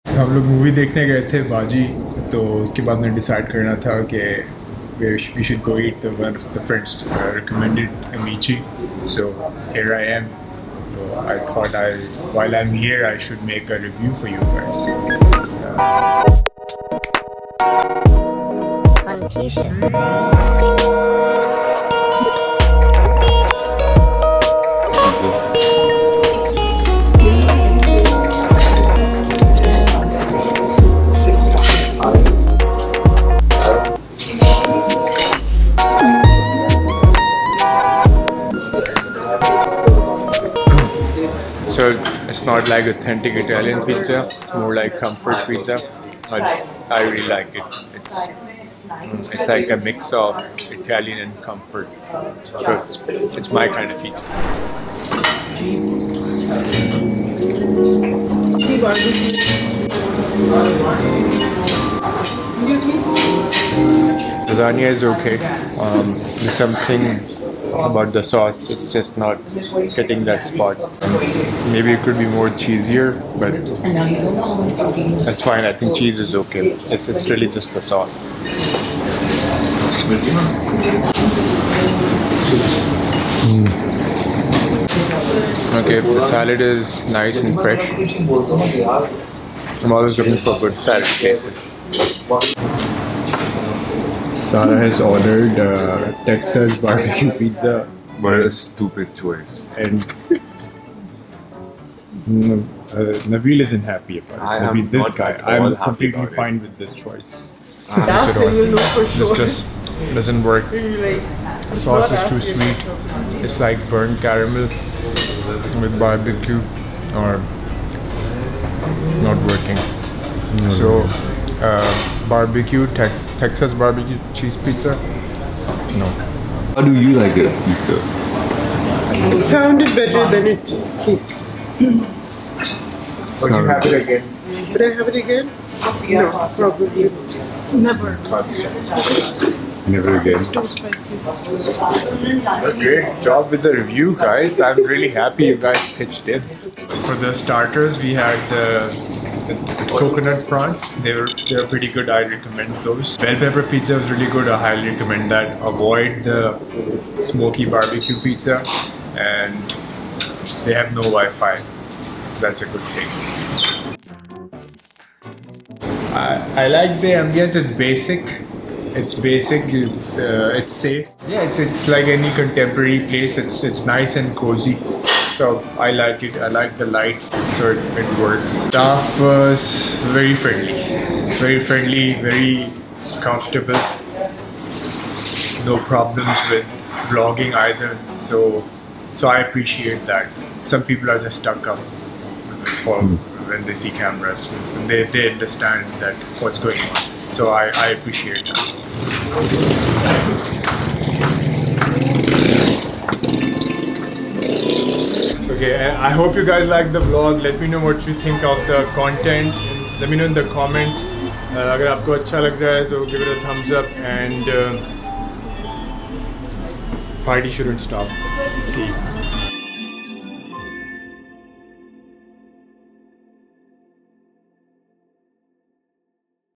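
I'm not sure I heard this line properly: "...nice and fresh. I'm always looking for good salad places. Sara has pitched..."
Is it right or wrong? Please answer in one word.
wrong.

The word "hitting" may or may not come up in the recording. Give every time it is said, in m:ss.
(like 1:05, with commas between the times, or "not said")
1:09.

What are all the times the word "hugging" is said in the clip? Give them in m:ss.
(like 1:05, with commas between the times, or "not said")
not said.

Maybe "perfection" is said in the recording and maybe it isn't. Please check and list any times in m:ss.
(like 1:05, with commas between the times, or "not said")
not said.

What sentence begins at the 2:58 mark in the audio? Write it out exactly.
Staff was very friendly, very friendly, very comfortable.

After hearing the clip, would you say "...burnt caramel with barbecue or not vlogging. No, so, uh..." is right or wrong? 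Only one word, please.
wrong.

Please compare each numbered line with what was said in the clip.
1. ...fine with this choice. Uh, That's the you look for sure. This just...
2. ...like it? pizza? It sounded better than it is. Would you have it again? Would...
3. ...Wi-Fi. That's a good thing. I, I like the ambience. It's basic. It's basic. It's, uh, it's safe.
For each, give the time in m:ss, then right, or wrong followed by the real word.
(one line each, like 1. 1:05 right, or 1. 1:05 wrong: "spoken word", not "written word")
1. 1:46 right
2. 2:07 right
3. 2:41 right.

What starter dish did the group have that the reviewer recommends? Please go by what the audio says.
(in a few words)
Coconut prawns.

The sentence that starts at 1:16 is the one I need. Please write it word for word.
It's, it's really just the sauce.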